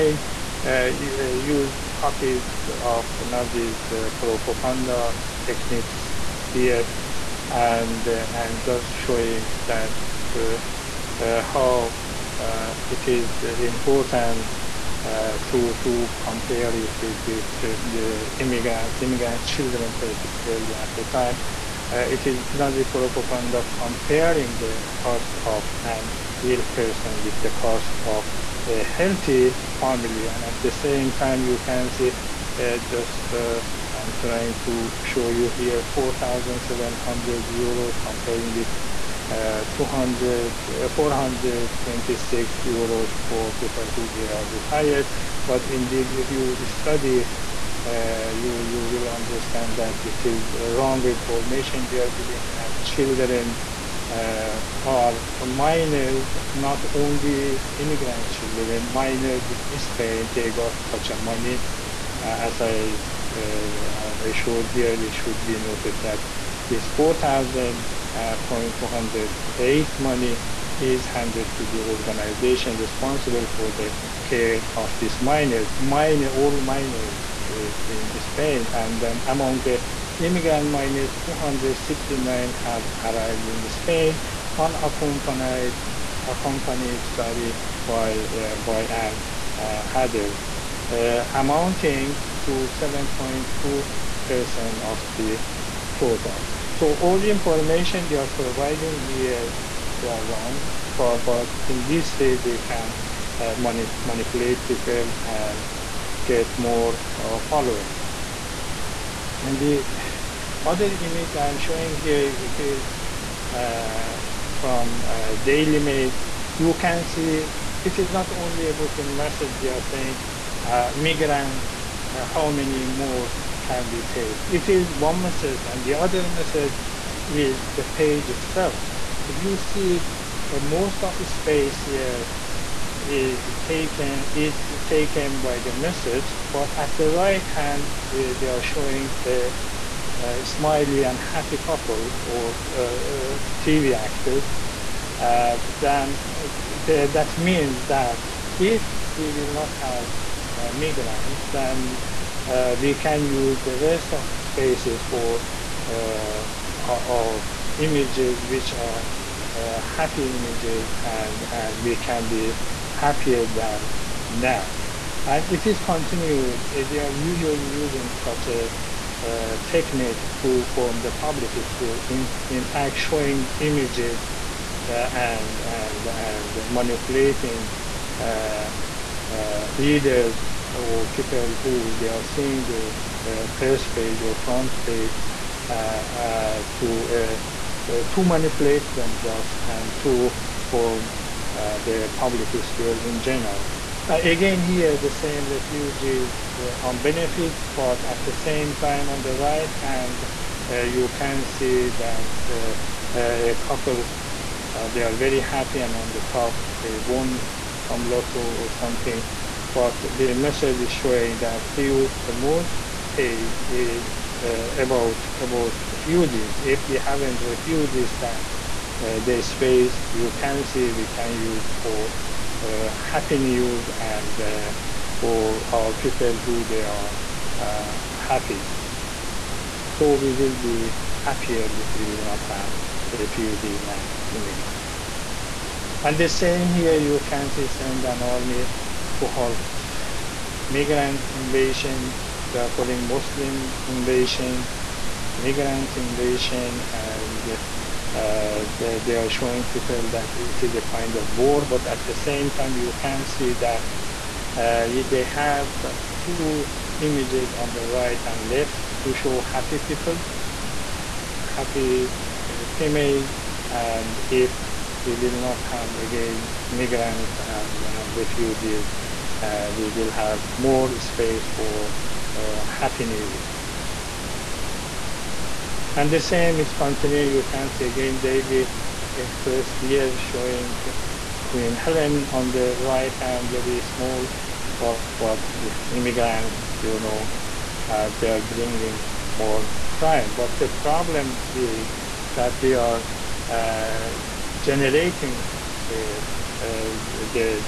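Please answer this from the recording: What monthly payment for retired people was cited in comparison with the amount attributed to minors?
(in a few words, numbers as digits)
426 euros.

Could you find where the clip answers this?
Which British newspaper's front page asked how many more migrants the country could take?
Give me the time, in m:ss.
1:55.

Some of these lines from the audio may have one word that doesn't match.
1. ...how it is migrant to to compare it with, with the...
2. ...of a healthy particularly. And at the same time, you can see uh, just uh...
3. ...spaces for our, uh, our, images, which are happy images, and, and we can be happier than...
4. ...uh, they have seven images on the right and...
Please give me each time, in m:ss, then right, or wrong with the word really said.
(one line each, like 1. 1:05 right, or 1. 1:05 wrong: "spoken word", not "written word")
1. 0:11 wrong: "important", not "migrant"
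2. 0:28 wrong: "family", not "particularly"
3. 2:34 right
4. 4:14 wrong: "two", not "seven".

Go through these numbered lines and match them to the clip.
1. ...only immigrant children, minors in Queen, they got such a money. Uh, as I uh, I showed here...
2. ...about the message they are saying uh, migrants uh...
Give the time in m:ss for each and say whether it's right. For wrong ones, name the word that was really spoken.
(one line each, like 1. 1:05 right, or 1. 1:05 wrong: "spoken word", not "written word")
1. 0:56 wrong: "Spain", not "Queen"
2. 1:58 right.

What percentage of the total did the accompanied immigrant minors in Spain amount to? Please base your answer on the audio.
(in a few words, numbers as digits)
7.2%.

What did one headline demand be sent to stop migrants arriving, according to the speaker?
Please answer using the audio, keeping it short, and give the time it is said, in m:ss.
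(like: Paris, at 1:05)
an army, at 3:58.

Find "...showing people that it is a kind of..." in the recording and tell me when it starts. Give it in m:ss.
4:09.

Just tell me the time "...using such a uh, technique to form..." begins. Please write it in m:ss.
2:47.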